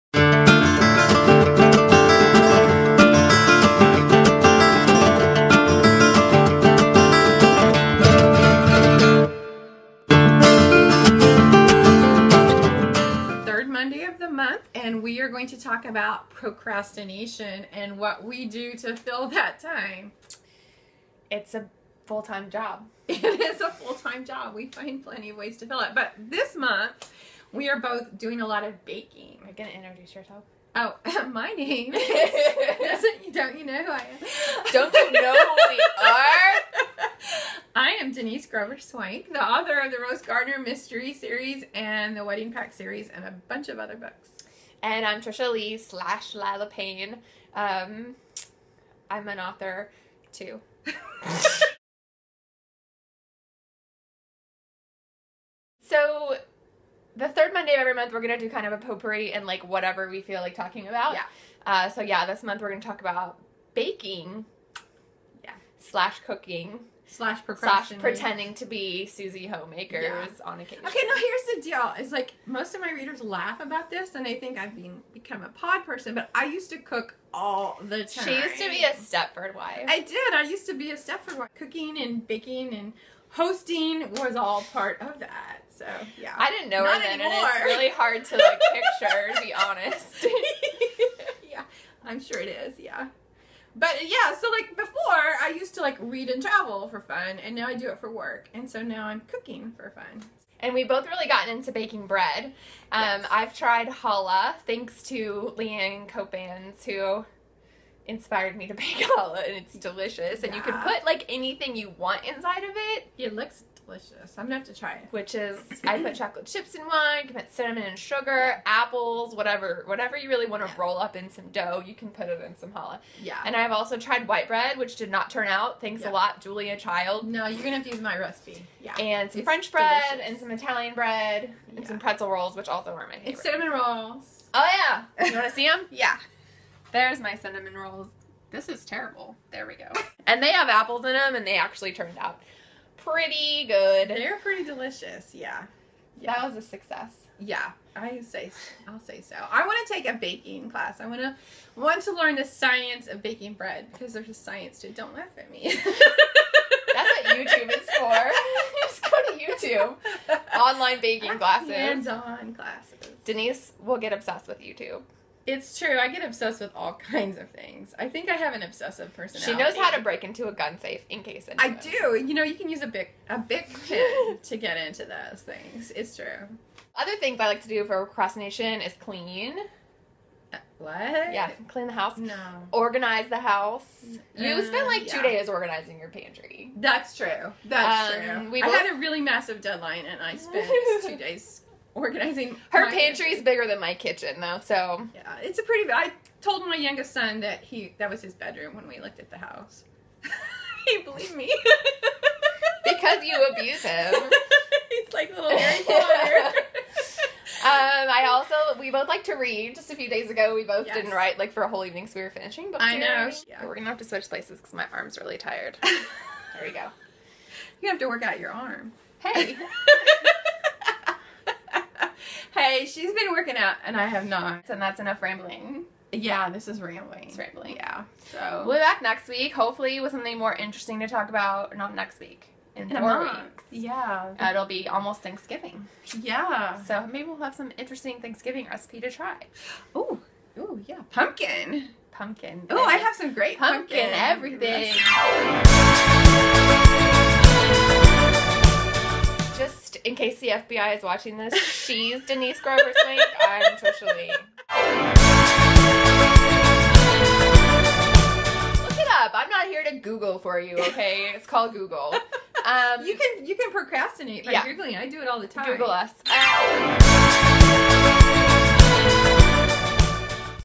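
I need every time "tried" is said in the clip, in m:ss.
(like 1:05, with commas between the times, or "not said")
1:43, 2:03.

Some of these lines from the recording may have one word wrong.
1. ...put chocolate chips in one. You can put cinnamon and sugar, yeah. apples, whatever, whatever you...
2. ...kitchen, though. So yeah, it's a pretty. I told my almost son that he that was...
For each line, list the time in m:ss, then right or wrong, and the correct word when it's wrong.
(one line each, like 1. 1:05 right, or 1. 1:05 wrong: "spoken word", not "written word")
1. 1:56 right
2. 3:13 wrong: "youngest", not "almost".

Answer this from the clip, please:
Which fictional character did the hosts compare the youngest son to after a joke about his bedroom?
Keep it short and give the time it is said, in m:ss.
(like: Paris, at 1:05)
Harry Potter, at 3:25.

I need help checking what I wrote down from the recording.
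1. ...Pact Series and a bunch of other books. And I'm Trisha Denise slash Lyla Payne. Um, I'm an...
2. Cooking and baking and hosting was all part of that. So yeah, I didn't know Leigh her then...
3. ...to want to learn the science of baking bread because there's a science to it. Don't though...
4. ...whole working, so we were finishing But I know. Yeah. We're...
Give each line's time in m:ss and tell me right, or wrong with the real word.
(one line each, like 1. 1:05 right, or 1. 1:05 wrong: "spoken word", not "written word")
1. 0:42 wrong: "Leigh", not "Denise"
2. 1:21 wrong: "Not", not "Leigh"
3. 2:31 wrong: "laugh", not "though"
4. 3:31 wrong: "evening", not "working".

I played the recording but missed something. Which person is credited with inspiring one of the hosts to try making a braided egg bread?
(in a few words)
Leanne Copans.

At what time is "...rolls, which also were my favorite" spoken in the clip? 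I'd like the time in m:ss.
2:12.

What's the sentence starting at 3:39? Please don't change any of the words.
Hey anyway, she's been working out and I have not.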